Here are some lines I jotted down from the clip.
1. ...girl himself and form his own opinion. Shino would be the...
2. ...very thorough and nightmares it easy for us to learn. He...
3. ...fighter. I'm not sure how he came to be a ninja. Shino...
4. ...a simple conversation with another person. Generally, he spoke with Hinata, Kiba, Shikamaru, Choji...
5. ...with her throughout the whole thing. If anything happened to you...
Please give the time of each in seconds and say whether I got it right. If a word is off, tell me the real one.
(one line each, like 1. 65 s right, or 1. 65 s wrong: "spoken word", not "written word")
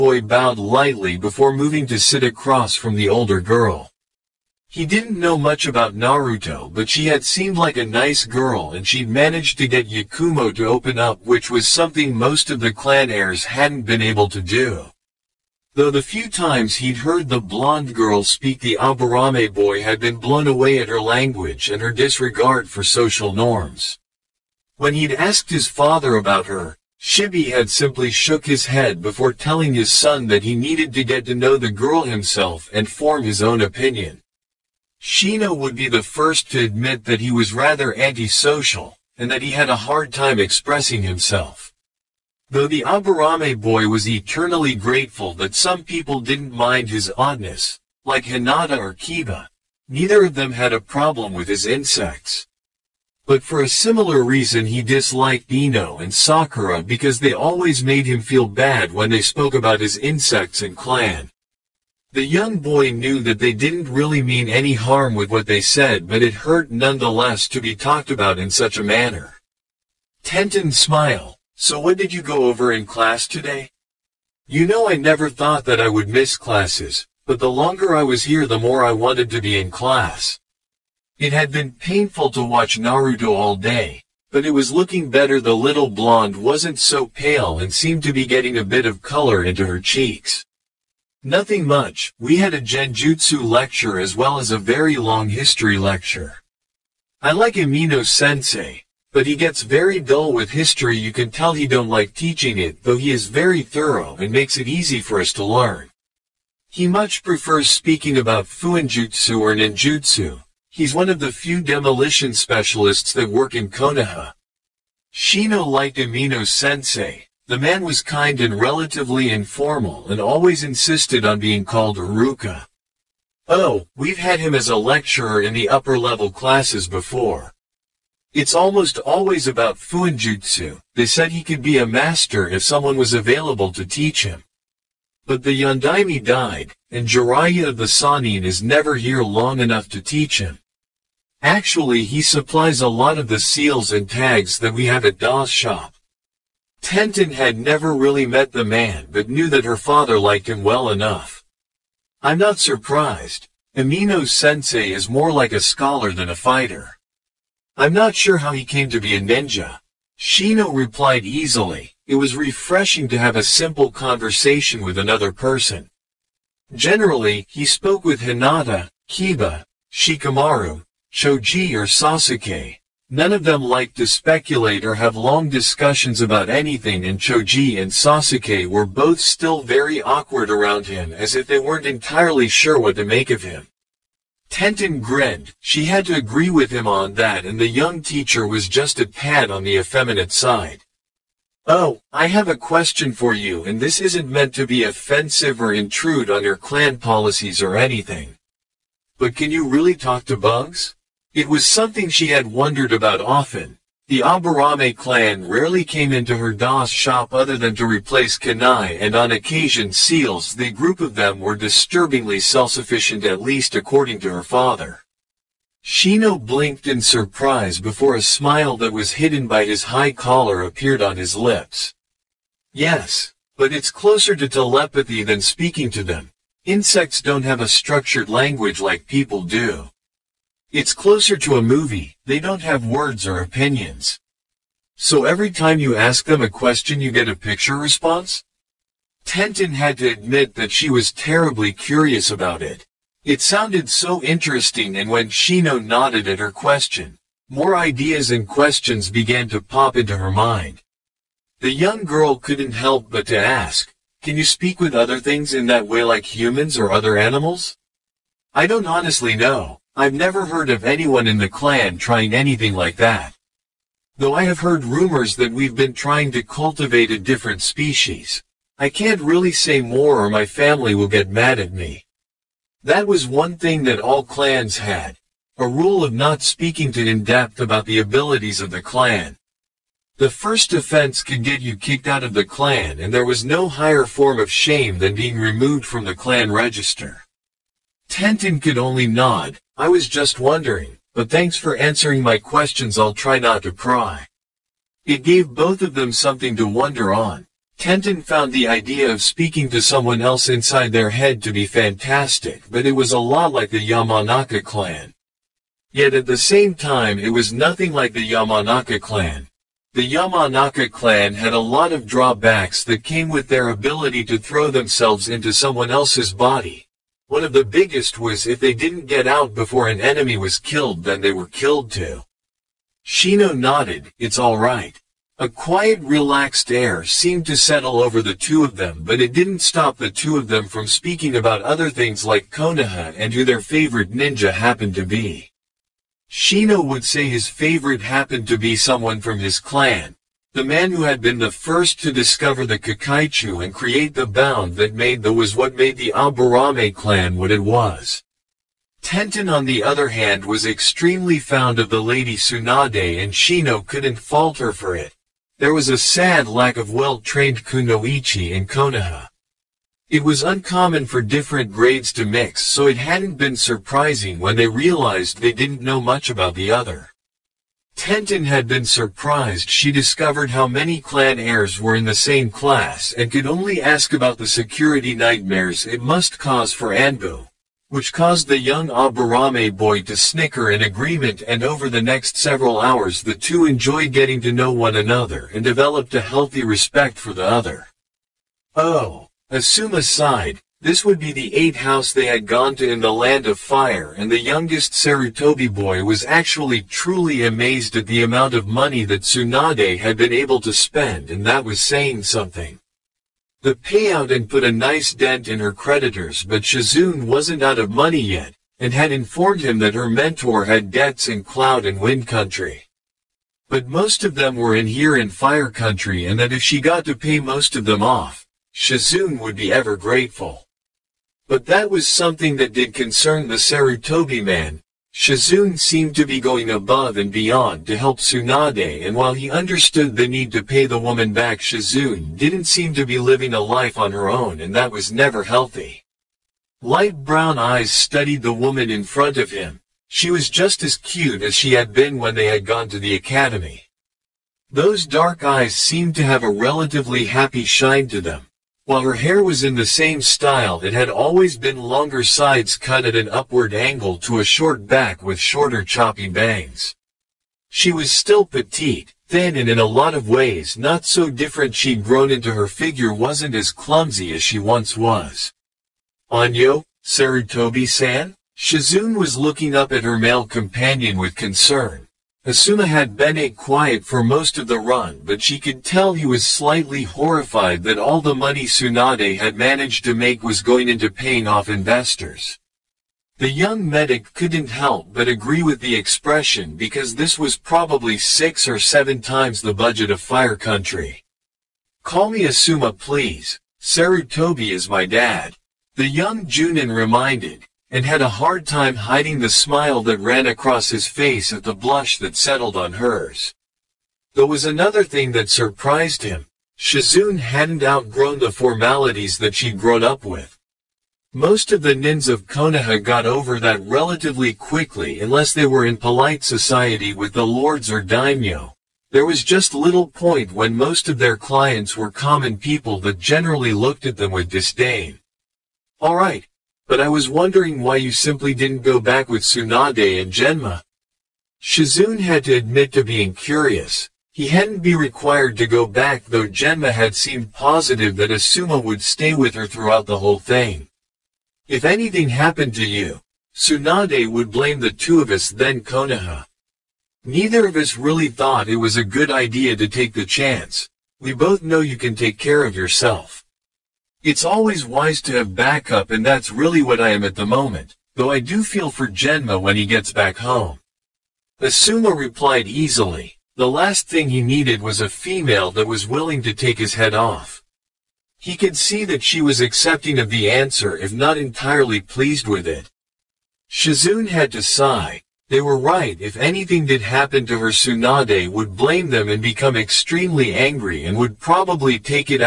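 1. 31 s right
2. 103 s wrong: "makes", not "nightmares"
3. 156 s right
4. 163 s right
5. 539 s right.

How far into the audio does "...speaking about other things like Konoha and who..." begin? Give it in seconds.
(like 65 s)
330 s.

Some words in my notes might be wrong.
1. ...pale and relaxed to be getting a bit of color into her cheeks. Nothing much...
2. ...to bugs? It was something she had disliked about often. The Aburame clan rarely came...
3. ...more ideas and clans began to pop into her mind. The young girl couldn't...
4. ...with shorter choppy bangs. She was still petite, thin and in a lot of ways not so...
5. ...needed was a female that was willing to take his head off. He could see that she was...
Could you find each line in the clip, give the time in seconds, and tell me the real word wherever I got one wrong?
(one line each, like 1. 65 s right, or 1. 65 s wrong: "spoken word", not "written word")
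1. 87 s wrong: "seemed", not "relaxed"
2. 200 s wrong: "wondered", not "disliked"
3. 247 s wrong: "questions", not "clans"
4. 455 s right
5. 564 s right.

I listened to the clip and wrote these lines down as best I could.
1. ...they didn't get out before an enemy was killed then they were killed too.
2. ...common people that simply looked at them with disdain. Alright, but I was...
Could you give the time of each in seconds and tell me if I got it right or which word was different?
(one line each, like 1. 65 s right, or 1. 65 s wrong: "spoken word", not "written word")
1. 318 s right
2. 522 s wrong: "generally", not "simply".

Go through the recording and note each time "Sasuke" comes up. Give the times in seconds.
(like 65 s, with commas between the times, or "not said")
171 s, 177 s.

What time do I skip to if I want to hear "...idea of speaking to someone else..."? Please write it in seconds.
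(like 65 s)
298 s.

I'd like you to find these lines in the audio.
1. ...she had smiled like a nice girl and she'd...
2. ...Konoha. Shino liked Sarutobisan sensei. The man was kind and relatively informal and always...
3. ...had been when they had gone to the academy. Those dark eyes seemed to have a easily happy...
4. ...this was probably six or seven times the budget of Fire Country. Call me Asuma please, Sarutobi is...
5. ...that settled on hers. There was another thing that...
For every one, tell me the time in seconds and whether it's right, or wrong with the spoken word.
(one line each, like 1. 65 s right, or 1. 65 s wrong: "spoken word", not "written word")
1. 6 s wrong: "seemed", not "smiled"
2. 113 s wrong: "Umino", not "Sarutobisan"
3. 441 s wrong: "relatively", not "easily"
4. 487 s right
5. 502 s right.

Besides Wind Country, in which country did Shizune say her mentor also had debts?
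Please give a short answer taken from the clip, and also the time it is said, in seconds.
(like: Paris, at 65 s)
Cloud, at 411 s.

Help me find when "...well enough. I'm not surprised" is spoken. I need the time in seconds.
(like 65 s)
150 s.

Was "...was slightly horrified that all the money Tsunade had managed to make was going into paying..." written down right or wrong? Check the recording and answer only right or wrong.
right.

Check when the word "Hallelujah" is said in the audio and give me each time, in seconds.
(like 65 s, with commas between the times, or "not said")
not said.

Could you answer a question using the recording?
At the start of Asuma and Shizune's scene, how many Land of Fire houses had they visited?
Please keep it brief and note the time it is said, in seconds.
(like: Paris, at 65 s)
8, at 391 s.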